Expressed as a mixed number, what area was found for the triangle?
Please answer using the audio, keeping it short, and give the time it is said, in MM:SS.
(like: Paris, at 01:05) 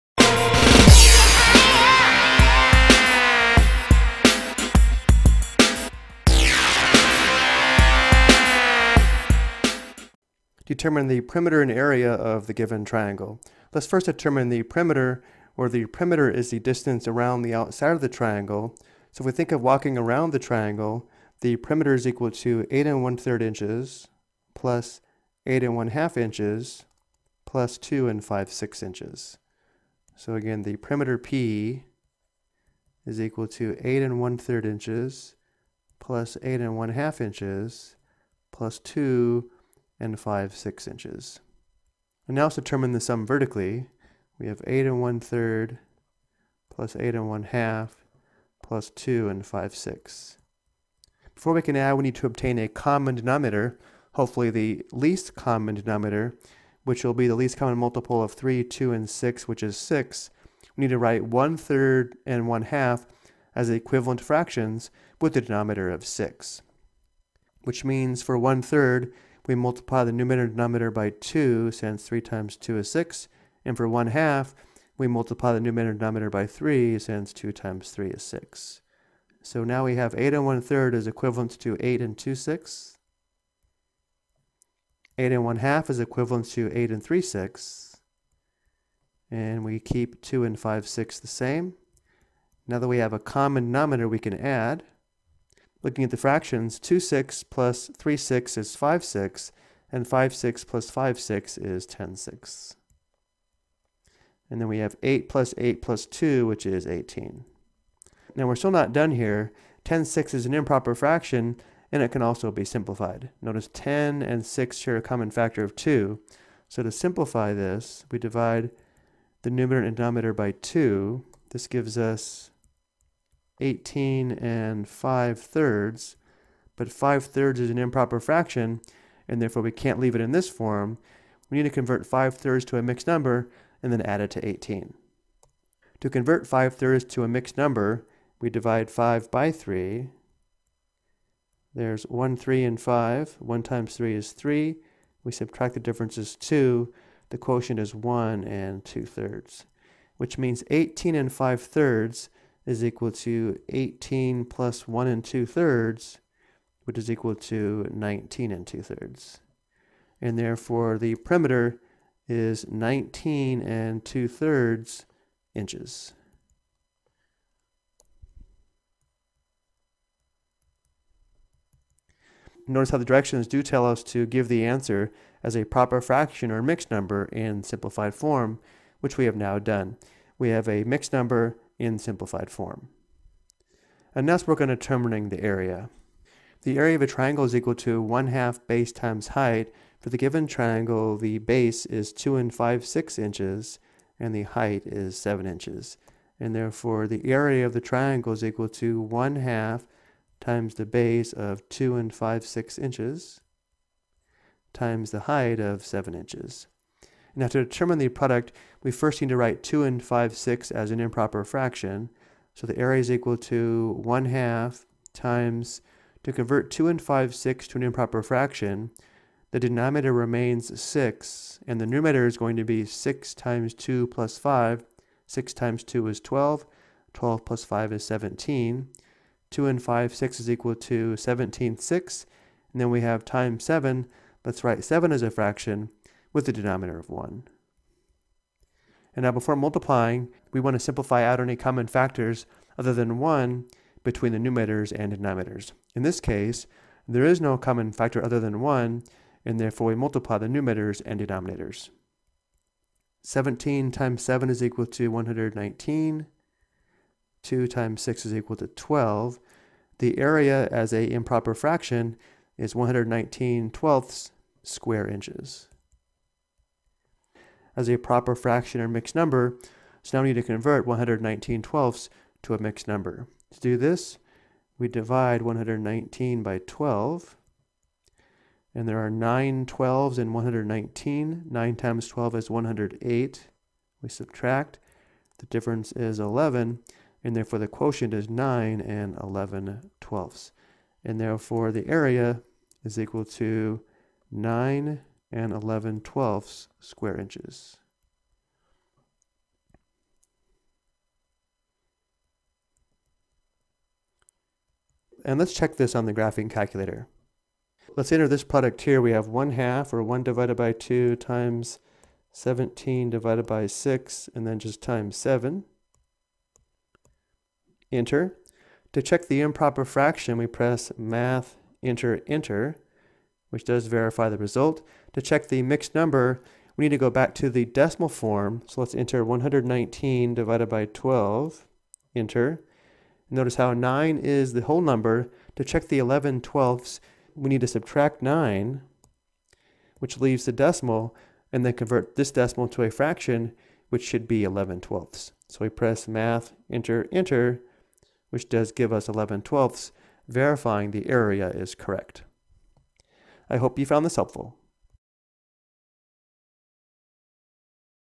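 9 11/12 square inches, at 04:54.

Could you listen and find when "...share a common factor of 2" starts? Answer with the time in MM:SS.
01:54.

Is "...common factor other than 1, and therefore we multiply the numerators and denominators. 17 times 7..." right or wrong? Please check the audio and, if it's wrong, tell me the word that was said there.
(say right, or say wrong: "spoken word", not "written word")
right.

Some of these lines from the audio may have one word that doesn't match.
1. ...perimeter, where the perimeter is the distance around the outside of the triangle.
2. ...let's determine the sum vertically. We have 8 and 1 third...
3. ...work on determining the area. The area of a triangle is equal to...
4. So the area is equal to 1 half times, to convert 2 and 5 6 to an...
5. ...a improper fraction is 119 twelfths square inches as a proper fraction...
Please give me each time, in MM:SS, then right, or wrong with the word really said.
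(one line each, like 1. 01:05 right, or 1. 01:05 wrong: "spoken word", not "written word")
1. 00:14 right
2. 00:42 right
3. 03:04 right
4. 03:32 right
5. 04:20 right.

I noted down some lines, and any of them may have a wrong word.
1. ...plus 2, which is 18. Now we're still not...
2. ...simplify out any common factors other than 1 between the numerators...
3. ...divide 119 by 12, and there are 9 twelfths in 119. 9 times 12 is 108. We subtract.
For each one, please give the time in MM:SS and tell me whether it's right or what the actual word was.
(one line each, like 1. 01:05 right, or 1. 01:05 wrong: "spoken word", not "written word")
1. 01:45 right
2. 04:00 right
3. 04:34 right.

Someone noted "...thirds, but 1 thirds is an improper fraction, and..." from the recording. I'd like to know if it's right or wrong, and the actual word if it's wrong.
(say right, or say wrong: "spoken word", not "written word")
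wrong: "5", not "1".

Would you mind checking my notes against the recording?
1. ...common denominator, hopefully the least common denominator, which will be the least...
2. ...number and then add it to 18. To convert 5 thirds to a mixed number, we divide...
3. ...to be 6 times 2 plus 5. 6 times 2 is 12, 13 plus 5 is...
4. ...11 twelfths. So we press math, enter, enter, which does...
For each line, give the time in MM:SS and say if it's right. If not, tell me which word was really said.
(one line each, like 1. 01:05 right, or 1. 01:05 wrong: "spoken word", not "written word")
1. 00:52 right
2. 02:13 right
3. 03:42 wrong: "12", not "13"
4. 05:44 right.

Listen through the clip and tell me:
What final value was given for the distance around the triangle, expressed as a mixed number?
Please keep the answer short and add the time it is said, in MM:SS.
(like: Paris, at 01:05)
19 2/3 inches, at 02:42.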